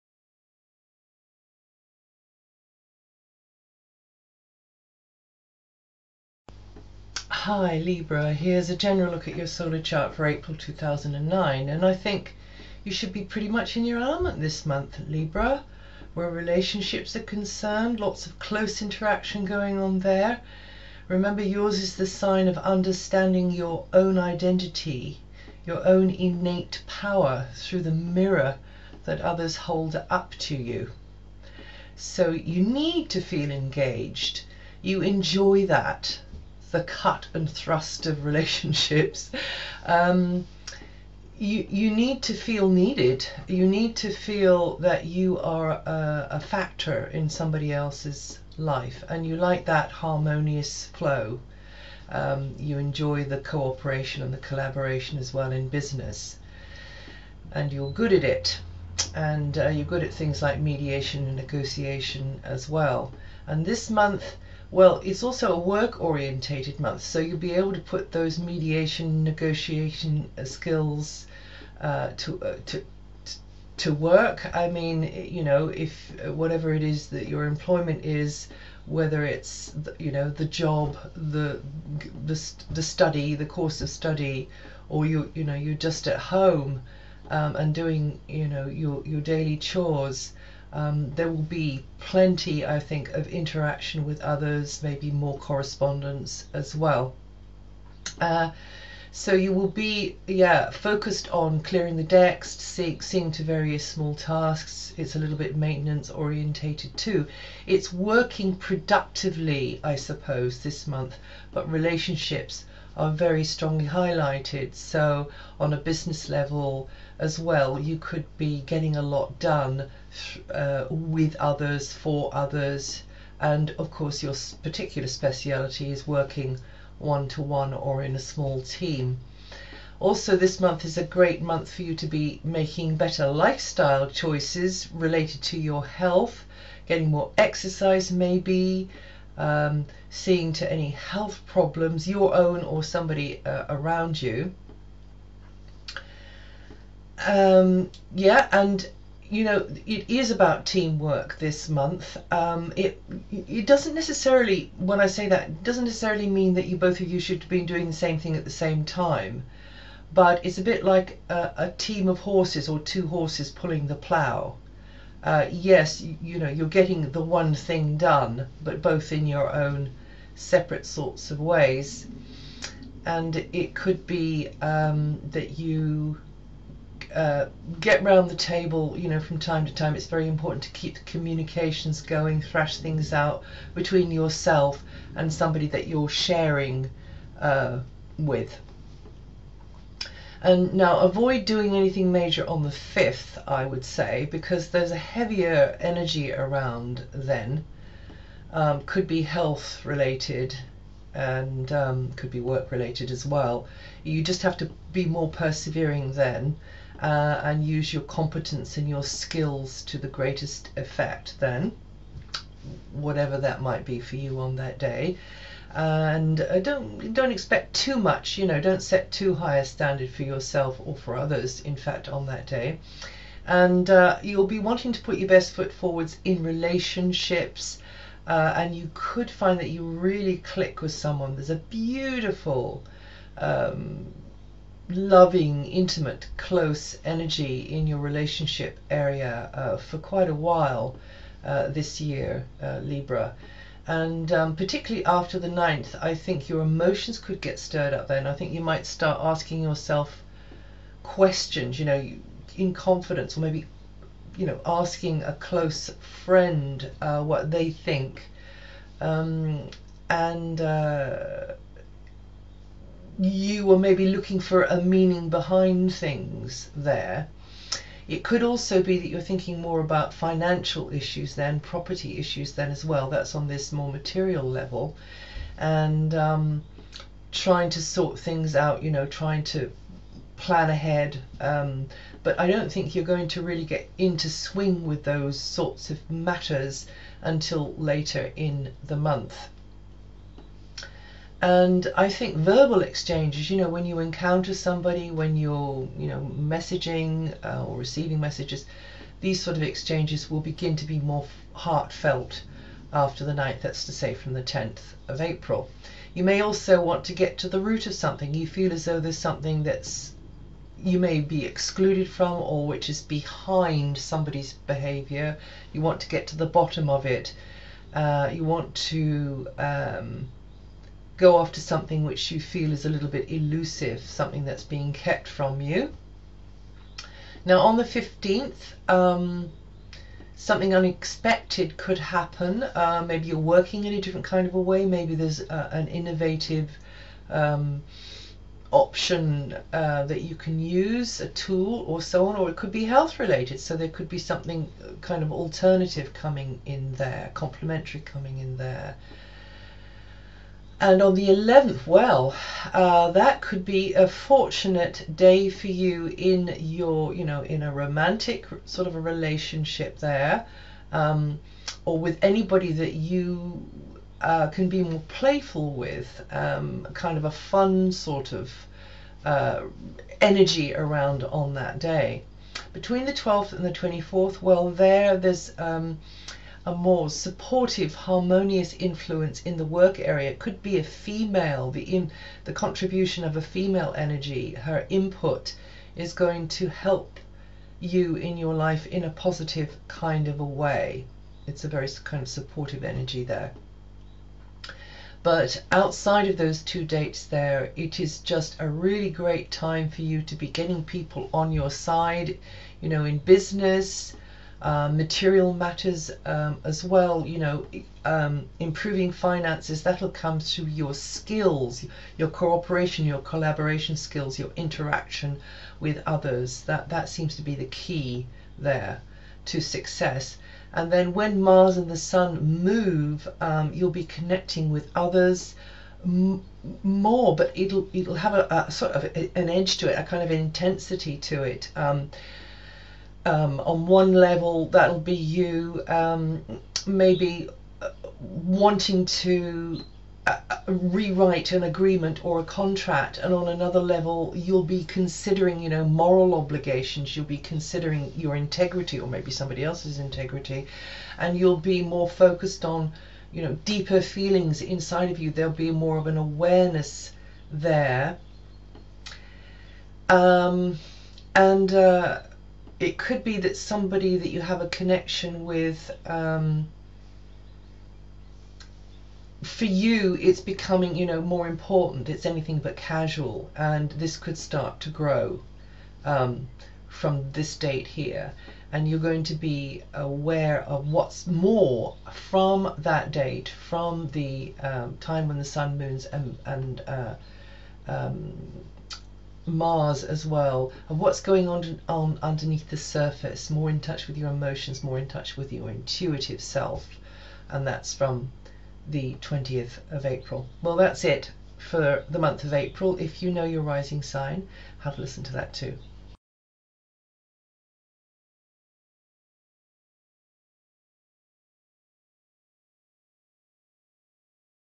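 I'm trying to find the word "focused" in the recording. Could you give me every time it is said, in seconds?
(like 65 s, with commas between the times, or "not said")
100 s, 452 s.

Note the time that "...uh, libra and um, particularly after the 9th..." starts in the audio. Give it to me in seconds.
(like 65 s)
242 s.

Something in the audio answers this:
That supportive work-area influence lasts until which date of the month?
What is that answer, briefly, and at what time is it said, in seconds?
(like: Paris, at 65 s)
24th, at 373 s.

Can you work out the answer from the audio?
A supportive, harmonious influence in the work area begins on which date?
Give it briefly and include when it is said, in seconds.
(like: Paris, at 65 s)
12th, at 373 s.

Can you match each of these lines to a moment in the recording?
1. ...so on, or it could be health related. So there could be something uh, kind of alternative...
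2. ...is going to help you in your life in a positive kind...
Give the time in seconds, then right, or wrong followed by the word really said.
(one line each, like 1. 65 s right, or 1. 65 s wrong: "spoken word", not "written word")
1. 342 s right
2. 385 s right.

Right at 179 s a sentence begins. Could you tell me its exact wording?
It's very important to keep communications going, thrash things out between yourself and somebody that you're sharing uh, with.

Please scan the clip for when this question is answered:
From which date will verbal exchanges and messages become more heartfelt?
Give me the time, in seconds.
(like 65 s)
304 s.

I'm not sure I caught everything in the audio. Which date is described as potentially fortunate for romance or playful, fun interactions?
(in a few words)
11th.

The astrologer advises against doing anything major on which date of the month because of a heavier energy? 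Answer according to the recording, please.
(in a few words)
5th.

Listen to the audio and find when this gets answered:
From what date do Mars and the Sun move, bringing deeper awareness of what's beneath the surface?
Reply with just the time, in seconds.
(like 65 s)
499 s.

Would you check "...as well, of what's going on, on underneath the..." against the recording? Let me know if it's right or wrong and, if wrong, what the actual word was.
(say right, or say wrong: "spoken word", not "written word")
right.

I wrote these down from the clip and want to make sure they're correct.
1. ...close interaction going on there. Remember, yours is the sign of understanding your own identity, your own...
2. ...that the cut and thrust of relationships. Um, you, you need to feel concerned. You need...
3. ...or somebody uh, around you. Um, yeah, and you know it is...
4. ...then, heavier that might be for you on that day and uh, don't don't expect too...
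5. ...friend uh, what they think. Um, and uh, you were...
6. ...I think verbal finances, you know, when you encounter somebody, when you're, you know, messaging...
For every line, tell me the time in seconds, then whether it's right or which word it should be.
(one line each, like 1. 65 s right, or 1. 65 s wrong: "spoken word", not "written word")
1. 18 s right
2. 35 s wrong: "needed", not "concerned"
3. 142 s right
4. 211 s wrong: "whatever", not "heavier"
5. 256 s right
6. 291 s wrong: "exchanges", not "finances".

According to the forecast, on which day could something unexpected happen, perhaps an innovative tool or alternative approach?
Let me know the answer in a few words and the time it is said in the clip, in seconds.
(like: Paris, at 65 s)
15th, at 327 s.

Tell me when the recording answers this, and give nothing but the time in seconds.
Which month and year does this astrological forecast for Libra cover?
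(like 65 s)
10 s.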